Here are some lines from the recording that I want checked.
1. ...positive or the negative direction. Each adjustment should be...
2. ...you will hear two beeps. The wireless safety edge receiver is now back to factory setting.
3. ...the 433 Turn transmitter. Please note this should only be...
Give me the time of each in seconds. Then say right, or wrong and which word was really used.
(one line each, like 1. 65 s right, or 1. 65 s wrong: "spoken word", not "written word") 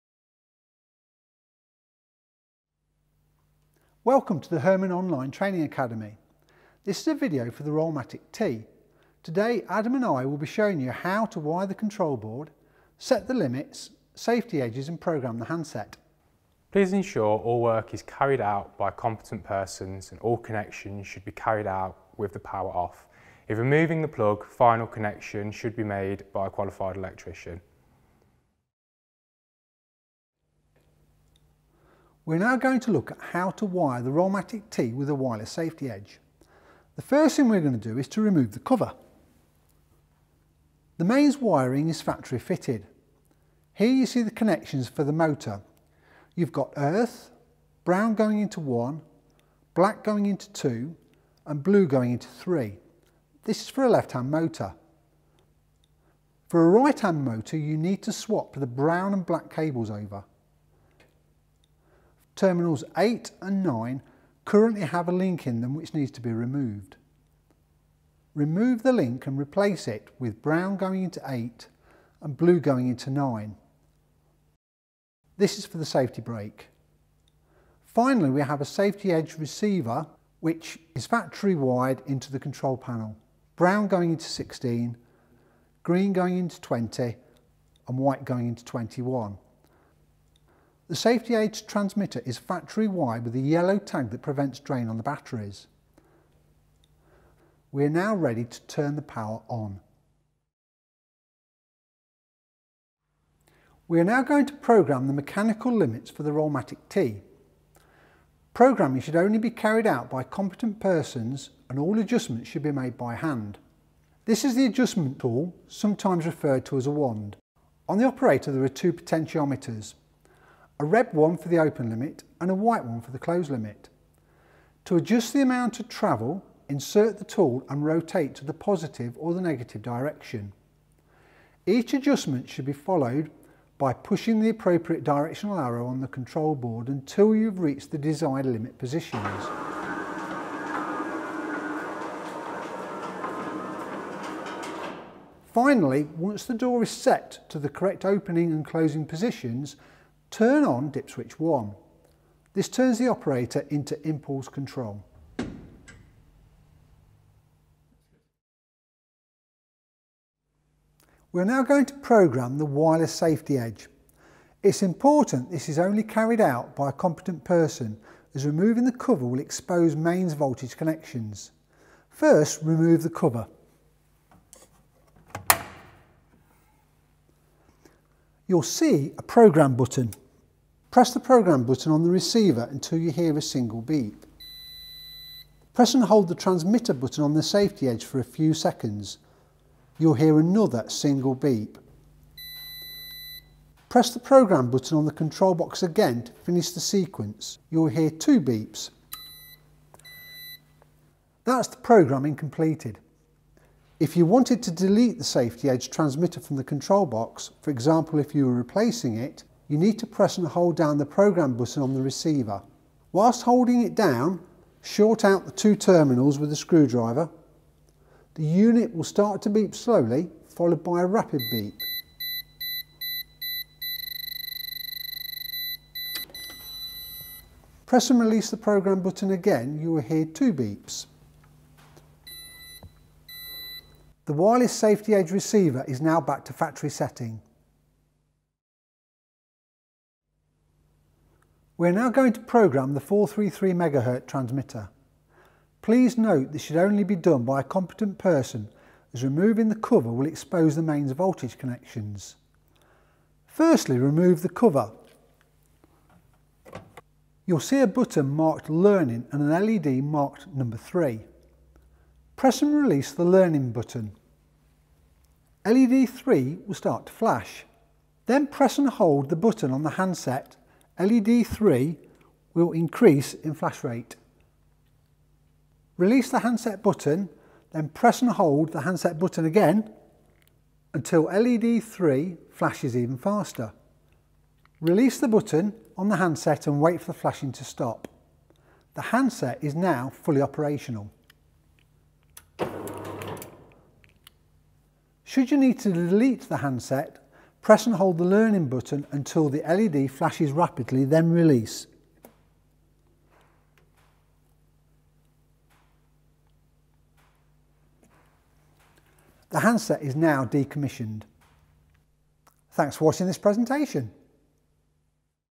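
1. 128 s right
2. 229 s right
3. 242 s wrong: "MHz", not "Turn".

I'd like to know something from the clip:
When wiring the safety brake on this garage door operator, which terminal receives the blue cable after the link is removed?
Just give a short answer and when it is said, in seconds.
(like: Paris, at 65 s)
9, at 72 s.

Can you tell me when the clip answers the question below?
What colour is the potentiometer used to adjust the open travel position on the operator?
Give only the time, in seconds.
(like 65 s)
120 s.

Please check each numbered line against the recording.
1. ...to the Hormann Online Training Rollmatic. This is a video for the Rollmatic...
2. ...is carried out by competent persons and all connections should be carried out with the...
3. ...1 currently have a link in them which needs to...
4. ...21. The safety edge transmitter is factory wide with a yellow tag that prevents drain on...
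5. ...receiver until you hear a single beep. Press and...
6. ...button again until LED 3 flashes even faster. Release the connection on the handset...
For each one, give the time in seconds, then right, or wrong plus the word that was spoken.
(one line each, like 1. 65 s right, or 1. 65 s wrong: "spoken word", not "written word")
1. 4 s wrong: "Academy", not "Rollmatic"
2. 17 s right
3. 63 s wrong: "9", not "1"
4. 88 s right
5. 182 s right
6. 279 s wrong: "button", not "connection".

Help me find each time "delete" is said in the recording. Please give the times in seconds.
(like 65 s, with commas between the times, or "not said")
204 s, 295 s.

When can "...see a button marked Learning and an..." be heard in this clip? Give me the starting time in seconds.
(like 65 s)
257 s.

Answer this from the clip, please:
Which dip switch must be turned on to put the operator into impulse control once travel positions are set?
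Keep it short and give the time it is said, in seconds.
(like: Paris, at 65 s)
Dip switch 1, at 150 s.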